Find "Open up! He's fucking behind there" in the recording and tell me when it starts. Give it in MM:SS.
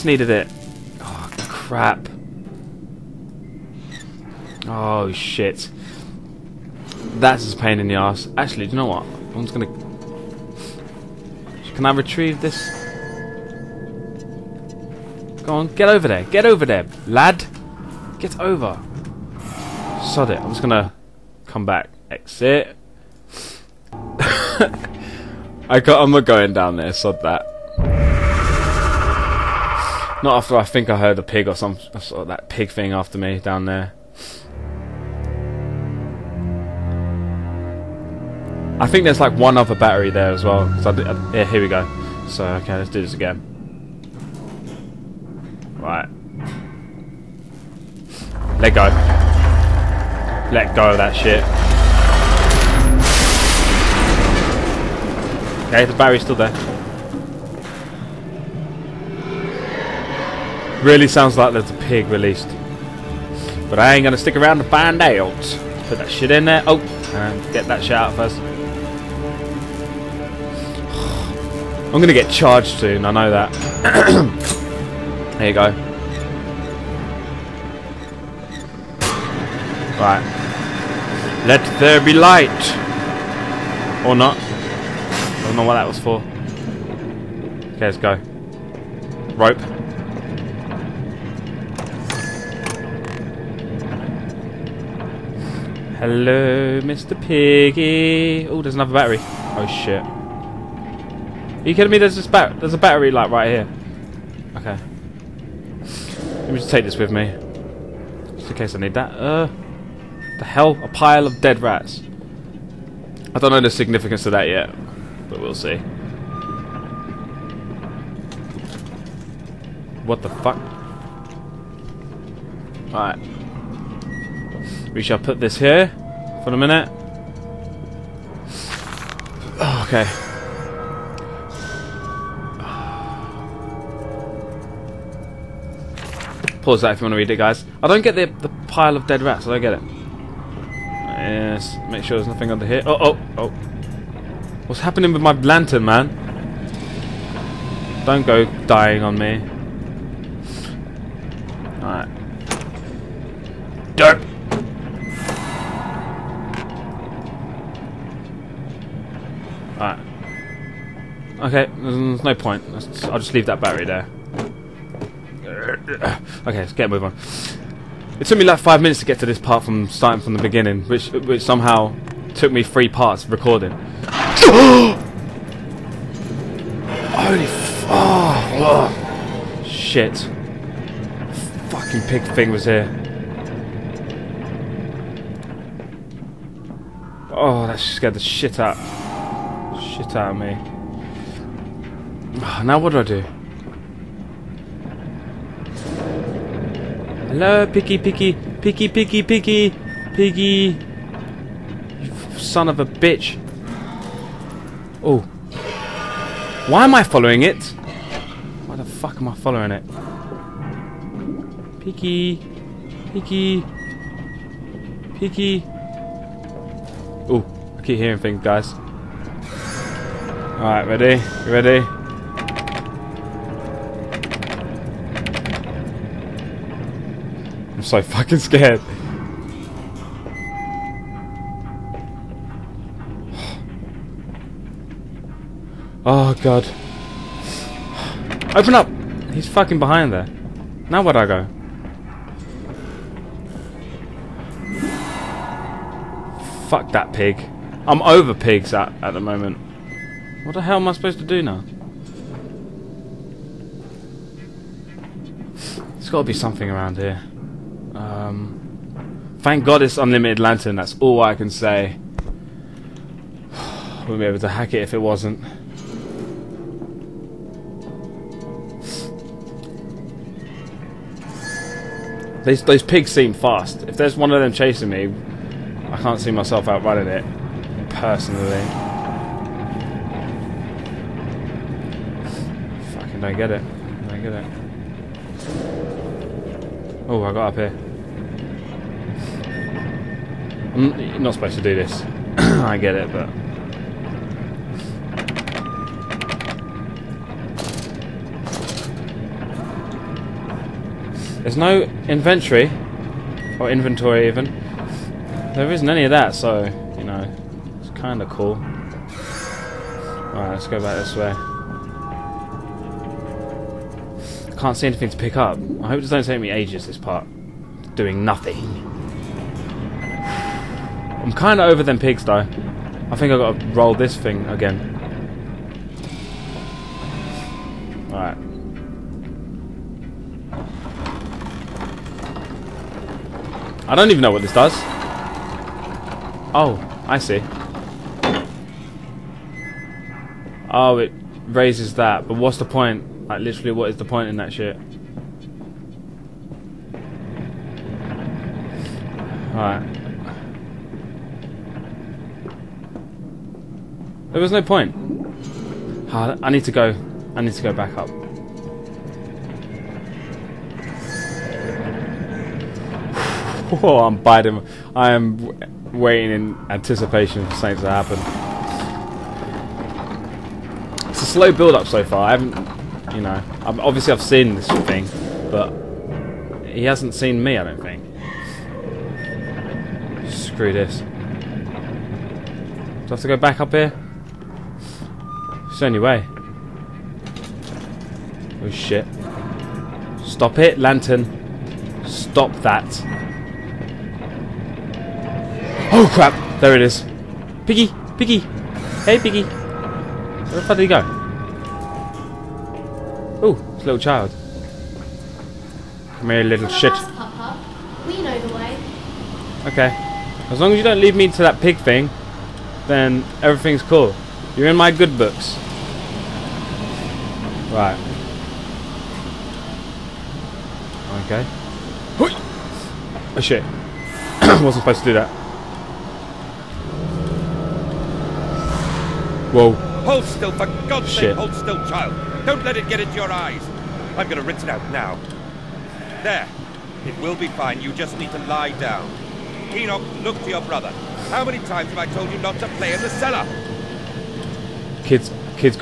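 03:58.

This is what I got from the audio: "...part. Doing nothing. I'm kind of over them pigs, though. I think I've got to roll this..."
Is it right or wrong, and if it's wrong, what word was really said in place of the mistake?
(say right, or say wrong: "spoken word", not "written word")
right.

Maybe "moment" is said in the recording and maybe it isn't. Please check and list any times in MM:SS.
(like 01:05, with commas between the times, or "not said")
04:09.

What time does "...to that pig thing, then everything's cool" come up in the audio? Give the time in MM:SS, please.
06:51.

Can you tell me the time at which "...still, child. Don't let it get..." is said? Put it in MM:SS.
07:11.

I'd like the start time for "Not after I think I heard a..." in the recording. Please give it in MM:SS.
00:30.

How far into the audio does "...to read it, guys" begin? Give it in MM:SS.
02:17.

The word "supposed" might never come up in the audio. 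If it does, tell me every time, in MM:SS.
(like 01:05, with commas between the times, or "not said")
04:10, 04:51, 07:04.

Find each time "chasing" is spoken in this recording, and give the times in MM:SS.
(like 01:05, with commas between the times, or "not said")
04:34.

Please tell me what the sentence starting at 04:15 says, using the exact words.
There's gotta be something around here.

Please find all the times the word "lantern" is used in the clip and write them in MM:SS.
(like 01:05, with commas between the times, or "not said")
02:25, 04:20, 06:30.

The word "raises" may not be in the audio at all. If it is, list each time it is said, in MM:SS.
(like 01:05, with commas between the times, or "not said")
05:41.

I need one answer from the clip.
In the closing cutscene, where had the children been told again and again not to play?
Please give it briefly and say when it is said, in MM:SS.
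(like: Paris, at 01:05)
The cellar, at 07:22.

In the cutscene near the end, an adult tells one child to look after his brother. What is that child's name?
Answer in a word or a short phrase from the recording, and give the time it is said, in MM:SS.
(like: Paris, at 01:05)
Enoch, at 07:19.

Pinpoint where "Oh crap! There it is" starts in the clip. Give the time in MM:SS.
06:35.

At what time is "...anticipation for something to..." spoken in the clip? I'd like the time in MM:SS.
06:06.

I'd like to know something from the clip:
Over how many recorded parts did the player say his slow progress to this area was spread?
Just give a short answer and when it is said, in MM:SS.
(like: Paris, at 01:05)
3, at 02:52.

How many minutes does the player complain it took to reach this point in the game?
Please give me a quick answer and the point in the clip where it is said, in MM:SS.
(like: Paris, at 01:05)
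5, at 02:48.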